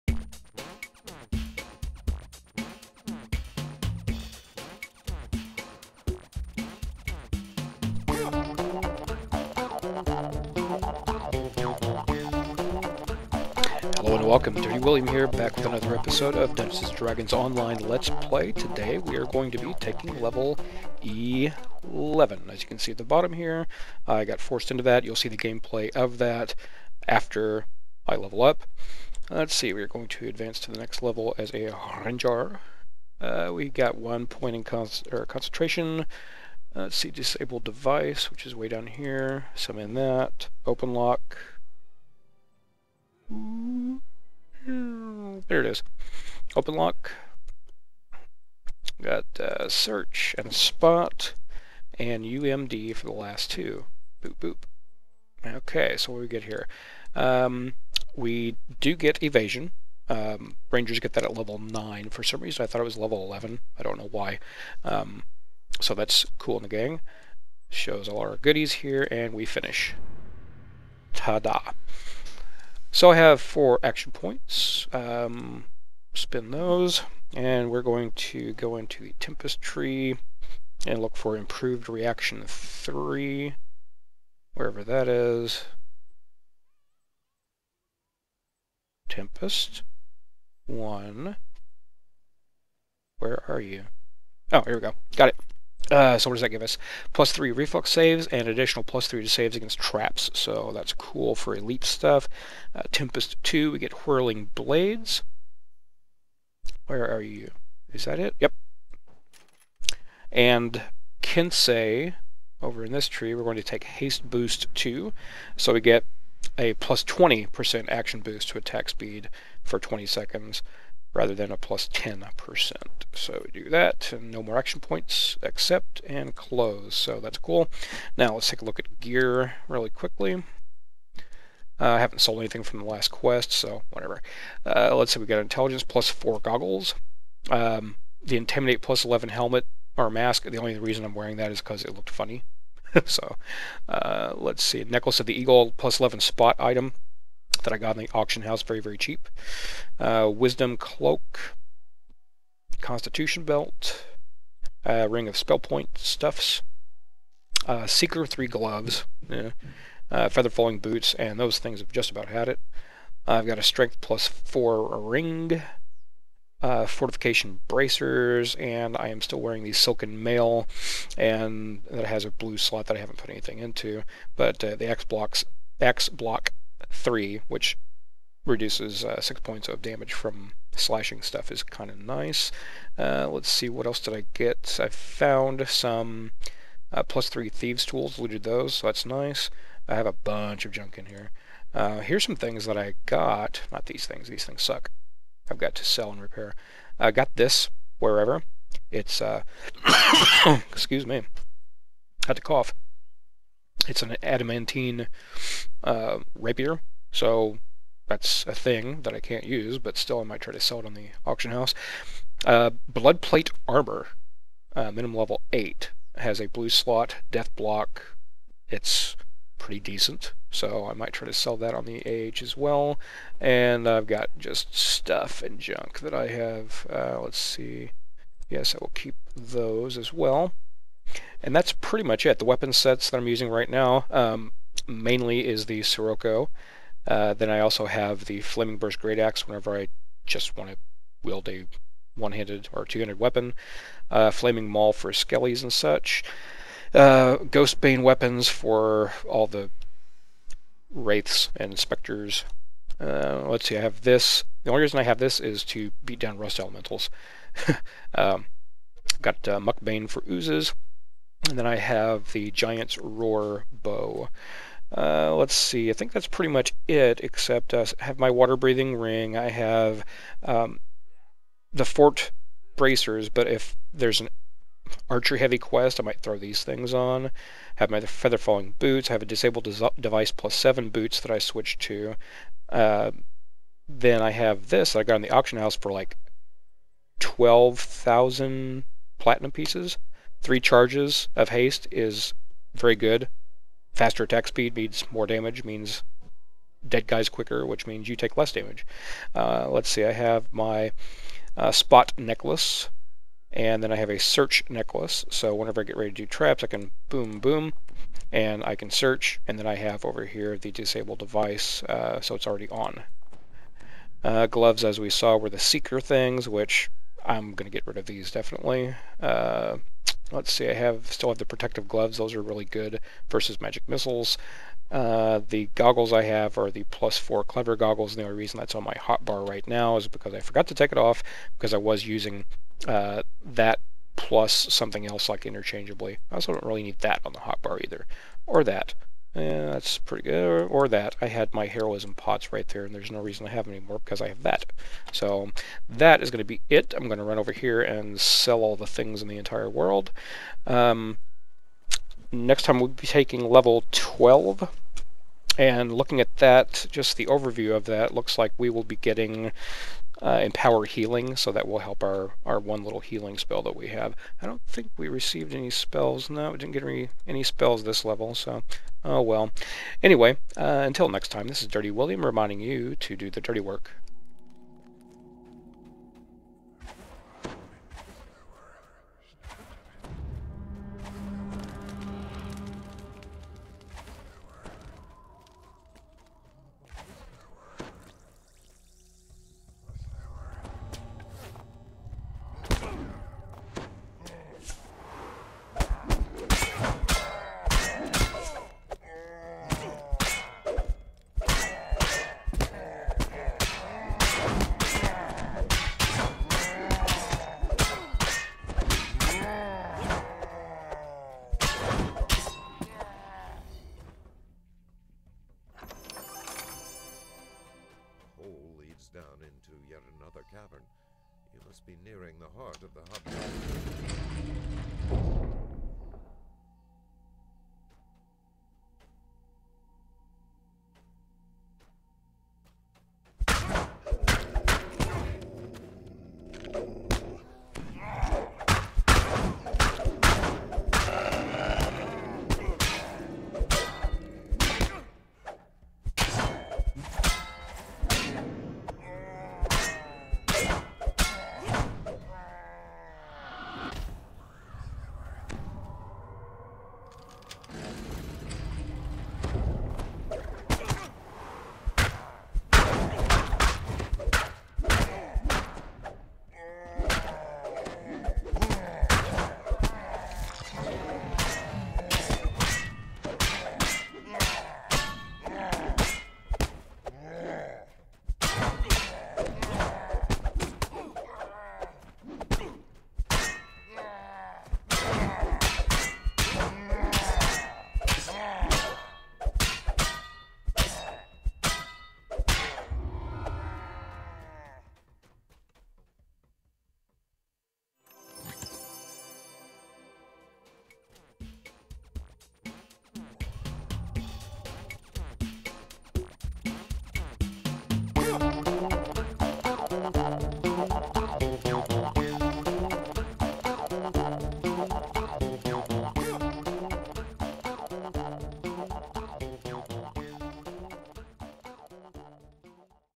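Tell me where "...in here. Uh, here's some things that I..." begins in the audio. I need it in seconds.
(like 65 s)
190 s.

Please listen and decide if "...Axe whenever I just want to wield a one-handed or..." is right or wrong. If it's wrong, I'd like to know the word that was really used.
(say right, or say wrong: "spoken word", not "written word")
right.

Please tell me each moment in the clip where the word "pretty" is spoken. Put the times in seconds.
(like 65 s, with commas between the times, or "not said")
219 s, 231 s, 266 s, 339 s.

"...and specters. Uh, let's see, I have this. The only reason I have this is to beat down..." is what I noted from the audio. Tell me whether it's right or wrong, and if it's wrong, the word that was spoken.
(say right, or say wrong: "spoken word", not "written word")
right.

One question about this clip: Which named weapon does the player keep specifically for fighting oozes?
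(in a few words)
Muckbane.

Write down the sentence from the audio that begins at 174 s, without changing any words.
But uh, the X blocks X block 3, which reduces uh, 6 points of damage from slashing stuff is kind of nice.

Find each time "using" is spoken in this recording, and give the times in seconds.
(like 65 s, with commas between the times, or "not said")
233 s, 332 s.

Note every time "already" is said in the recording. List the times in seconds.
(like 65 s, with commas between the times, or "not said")
312 s.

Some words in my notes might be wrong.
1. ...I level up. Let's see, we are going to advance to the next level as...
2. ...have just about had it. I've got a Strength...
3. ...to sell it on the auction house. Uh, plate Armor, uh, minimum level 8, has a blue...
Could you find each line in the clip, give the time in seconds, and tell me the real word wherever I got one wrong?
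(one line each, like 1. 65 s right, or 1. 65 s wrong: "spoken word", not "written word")
1. 28 s right
2. 161 s right
3. 210 s right.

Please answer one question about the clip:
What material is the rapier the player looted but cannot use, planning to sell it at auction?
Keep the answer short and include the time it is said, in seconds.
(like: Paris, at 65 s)
Adamantine, at 204 s.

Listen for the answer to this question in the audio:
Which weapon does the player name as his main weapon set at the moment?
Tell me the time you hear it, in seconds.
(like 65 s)
235 s.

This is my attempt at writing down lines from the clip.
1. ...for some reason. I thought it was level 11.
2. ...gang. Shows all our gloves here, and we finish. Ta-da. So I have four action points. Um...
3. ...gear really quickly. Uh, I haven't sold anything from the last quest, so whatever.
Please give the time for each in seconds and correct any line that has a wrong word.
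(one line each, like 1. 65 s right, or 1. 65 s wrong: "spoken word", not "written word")
1. 62 s right
2. 66 s wrong: "goodies", not "gloves"
3. 128 s right.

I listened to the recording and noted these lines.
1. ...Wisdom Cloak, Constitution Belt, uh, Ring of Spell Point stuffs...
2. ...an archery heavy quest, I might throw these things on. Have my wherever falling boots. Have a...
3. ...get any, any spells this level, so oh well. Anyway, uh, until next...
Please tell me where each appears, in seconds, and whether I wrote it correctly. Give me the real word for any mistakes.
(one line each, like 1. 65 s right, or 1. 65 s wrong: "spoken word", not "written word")
1. 150 s right
2. 274 s wrong: "feather", not "wherever"
3. 366 s right.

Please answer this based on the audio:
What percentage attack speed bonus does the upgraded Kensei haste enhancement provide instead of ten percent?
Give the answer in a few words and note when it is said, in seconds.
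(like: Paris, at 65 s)
20%, at 116 s.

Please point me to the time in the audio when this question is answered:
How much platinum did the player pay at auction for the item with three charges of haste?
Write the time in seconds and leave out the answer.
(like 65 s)
287 s.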